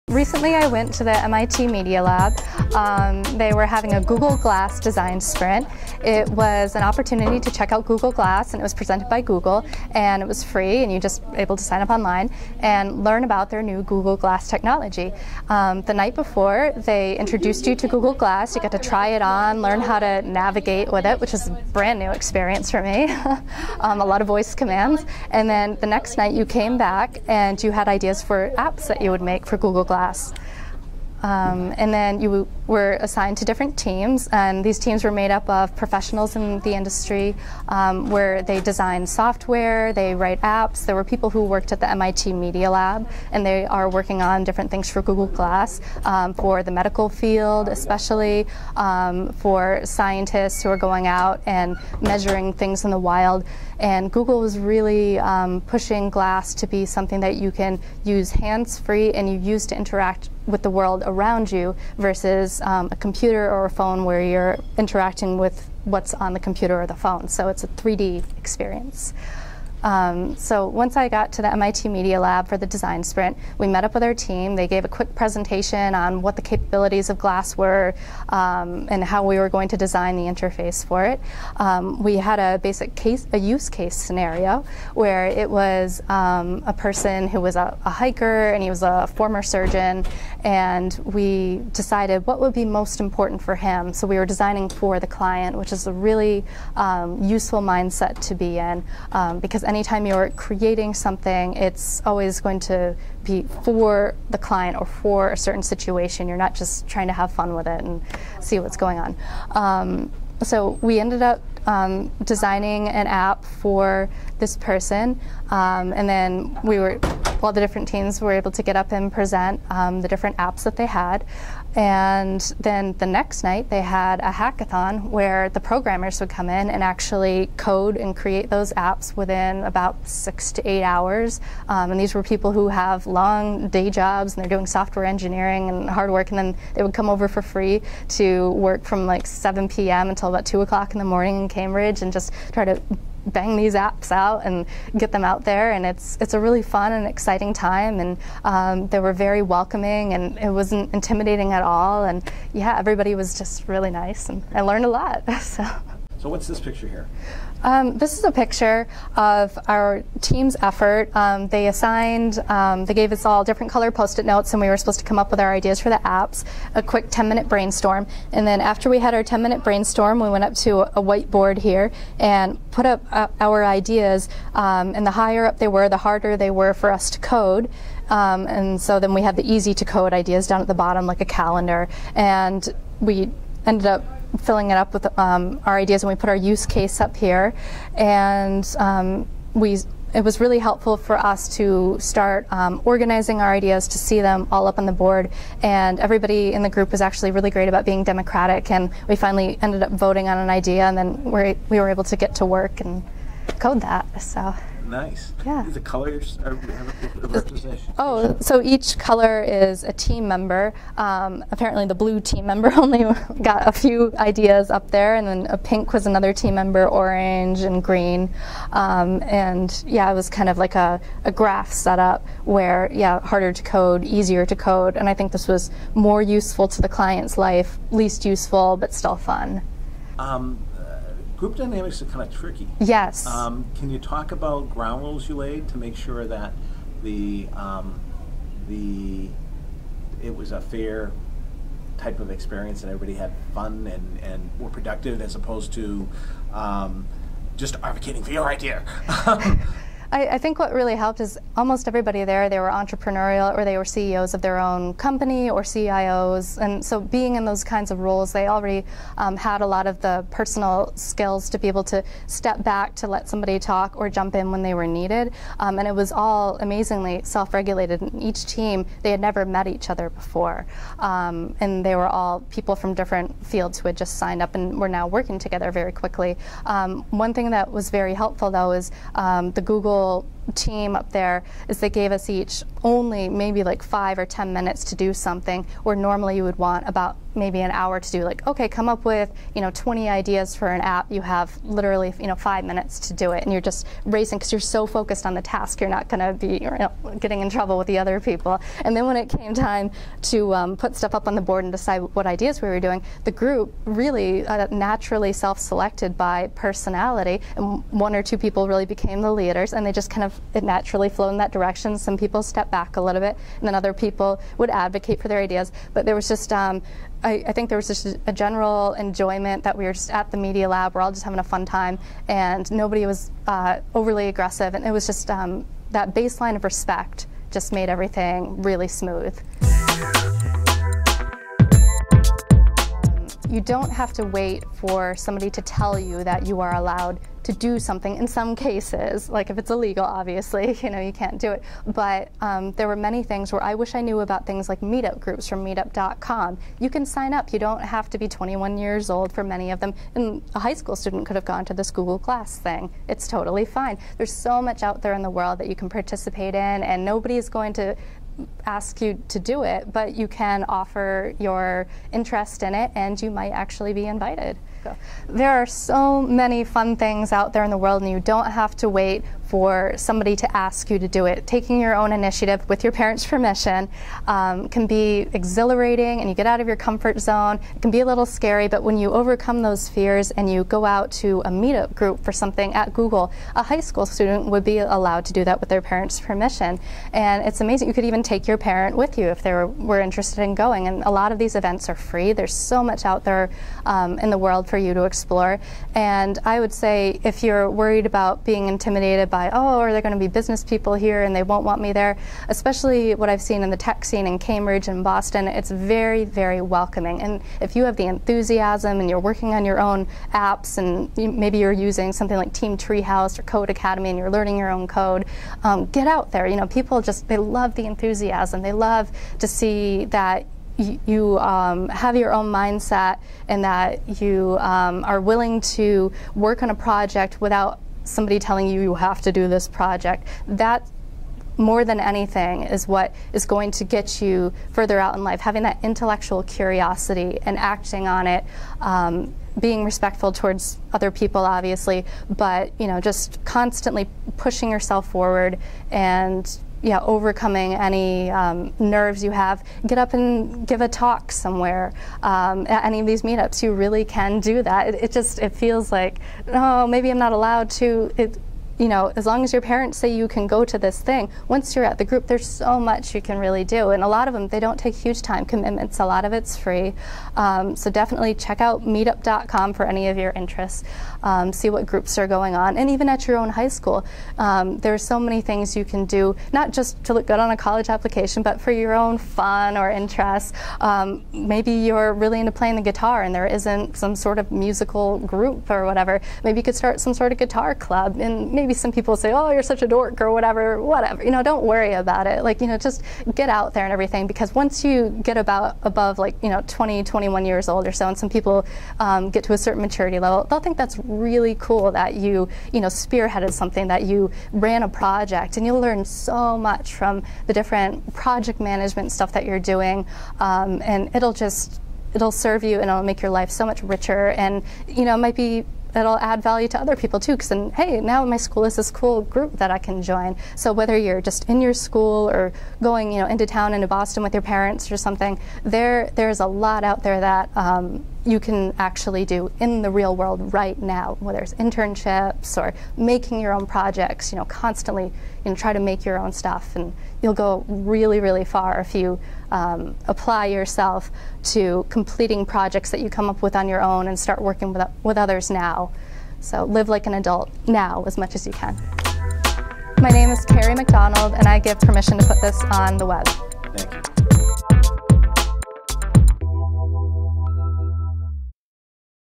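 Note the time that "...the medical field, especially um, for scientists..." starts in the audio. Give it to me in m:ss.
0:46.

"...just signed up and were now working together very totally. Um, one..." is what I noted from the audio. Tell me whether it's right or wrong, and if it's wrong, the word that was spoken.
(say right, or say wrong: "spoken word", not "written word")
wrong: "quickly", not "totally".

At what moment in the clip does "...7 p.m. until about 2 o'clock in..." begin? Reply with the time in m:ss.
2:19.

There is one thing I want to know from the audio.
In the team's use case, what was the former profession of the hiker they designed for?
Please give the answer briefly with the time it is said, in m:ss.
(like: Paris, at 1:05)
Surgeon, at 1:29.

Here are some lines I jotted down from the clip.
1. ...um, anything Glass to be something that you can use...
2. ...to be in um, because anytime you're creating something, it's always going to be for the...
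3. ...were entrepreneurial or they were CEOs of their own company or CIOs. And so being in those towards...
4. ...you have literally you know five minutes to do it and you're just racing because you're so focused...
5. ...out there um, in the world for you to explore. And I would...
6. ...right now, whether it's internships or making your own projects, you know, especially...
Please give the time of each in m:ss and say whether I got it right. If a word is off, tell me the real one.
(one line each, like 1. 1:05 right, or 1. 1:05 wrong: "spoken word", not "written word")
1. 0:55 wrong: "pushing", not "anything"
2. 1:38 right
3. 4:12 wrong: "kinds", not "towards"
4. 4:51 right
5. 6:33 right
6. 8:50 wrong: "constantly", not "especially".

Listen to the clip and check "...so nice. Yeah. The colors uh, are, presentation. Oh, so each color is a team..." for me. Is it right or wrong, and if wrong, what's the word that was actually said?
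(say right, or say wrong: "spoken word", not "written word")
wrong: "representation", not "presentation".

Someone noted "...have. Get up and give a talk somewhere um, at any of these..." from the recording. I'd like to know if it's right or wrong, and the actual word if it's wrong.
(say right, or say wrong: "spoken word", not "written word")
right.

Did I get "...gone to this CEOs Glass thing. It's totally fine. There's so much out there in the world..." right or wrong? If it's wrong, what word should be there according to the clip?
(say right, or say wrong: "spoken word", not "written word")
wrong: "Google", not "CEOs".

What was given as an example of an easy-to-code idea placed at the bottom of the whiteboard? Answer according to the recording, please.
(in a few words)
A calendar.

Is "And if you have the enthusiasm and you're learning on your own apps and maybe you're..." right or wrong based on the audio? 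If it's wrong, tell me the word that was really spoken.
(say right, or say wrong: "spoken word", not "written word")
wrong: "working", not "learning".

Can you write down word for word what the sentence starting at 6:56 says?
You know, people just, they love the enthusiasm.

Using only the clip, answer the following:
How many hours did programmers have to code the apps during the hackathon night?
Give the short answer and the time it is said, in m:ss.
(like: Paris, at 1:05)
6 to 8 hours, at 2:10.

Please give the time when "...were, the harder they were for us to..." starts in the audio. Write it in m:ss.
2:55.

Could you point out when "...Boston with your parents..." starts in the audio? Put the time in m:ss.
8:43.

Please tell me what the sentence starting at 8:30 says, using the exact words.
Um, and it'll just, it'll serve you and it'll make your life so much richer.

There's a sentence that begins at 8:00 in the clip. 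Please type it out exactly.
Um, maybe you're really into playing the guitar and there isn't some sort of musical group or whatever.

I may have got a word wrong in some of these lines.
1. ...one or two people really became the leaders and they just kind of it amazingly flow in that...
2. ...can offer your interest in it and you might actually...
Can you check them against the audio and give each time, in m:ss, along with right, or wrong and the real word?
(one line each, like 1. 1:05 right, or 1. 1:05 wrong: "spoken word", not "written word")
1. 5:07 wrong: "naturally", not "amazingly"
2. 6:00 right.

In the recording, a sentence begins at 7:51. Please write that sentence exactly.
Um, see what groups are going on.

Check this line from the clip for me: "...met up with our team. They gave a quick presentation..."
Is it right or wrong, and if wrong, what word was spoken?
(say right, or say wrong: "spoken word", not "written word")
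right.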